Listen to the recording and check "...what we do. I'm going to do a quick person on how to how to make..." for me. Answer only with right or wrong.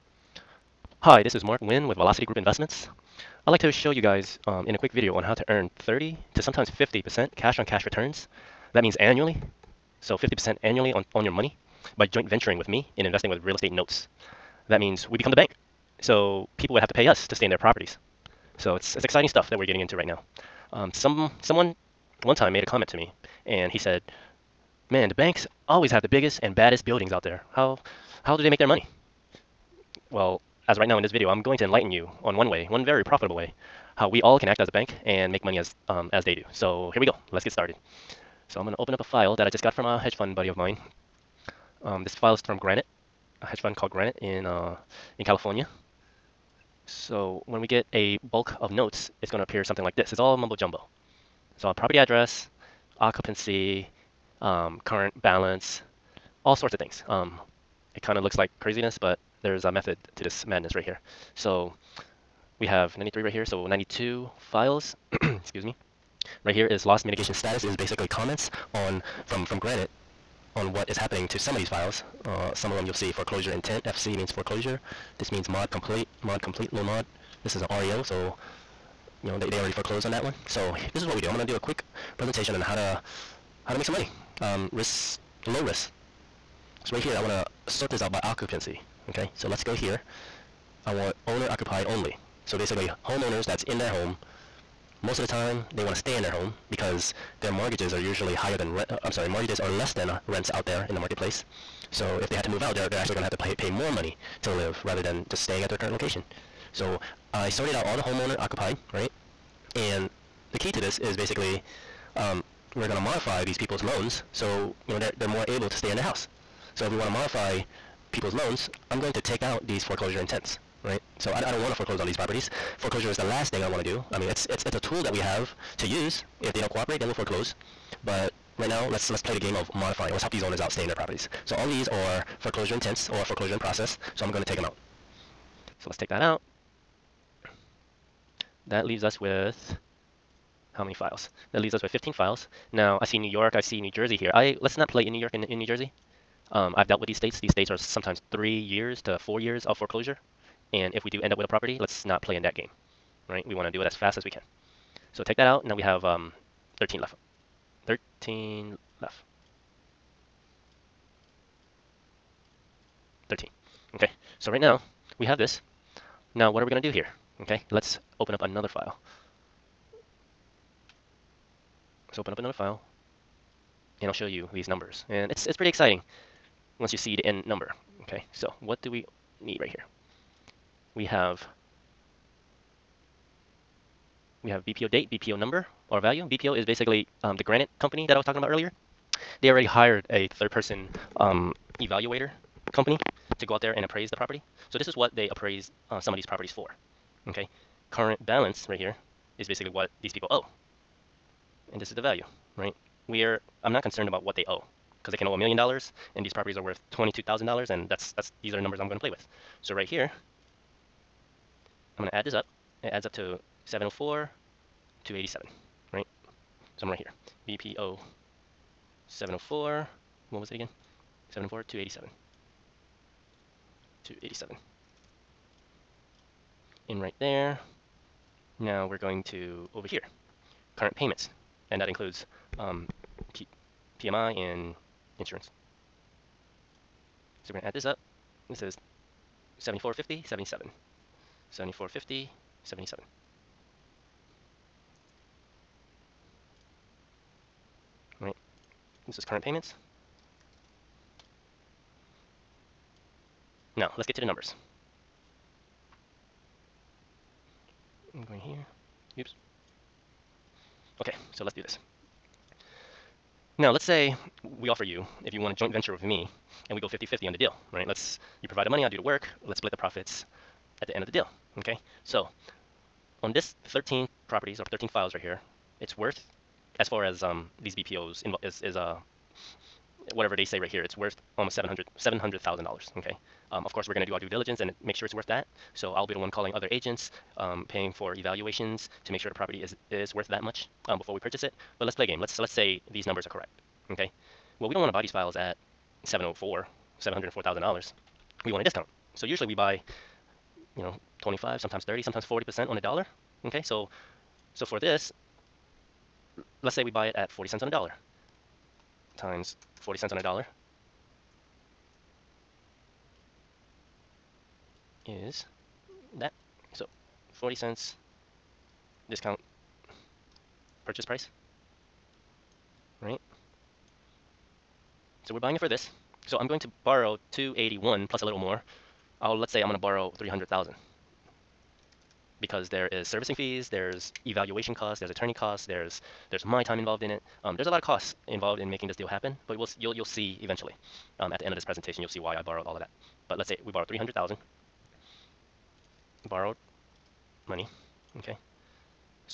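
wrong.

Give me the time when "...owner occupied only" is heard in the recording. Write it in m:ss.
1:31.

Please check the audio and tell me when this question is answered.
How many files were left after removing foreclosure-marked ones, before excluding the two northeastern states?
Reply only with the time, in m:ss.
2:21.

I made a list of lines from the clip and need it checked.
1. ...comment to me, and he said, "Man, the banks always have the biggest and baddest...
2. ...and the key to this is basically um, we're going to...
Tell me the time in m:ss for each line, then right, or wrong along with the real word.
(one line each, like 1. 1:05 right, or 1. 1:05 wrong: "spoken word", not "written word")
1. 0:22 right
2. 1:49 right.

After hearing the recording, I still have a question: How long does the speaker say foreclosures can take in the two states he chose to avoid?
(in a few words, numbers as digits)
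3 to 4 years.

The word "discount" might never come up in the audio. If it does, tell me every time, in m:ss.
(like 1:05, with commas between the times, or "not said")
4:58, 5:19.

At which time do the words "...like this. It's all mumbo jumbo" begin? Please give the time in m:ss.
0:49.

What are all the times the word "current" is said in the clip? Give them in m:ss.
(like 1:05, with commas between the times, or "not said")
0:54, 1:45, 3:17, 3:50, 4:09.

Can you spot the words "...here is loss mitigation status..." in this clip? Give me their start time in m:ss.
1:06.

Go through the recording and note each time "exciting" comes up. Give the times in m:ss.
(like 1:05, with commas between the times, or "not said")
0:19, 2:55.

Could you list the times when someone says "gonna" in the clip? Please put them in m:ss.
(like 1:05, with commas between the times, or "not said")
0:38, 2:46.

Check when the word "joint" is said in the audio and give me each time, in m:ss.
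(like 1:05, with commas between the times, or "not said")
0:12, 4:25.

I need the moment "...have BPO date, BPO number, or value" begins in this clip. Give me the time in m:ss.
3:04.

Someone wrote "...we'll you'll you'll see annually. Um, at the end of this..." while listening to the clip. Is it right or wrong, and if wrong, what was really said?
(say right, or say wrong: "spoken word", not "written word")
wrong: "eventually", not "annually".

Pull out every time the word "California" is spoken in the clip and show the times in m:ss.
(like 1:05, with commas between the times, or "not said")
0:45.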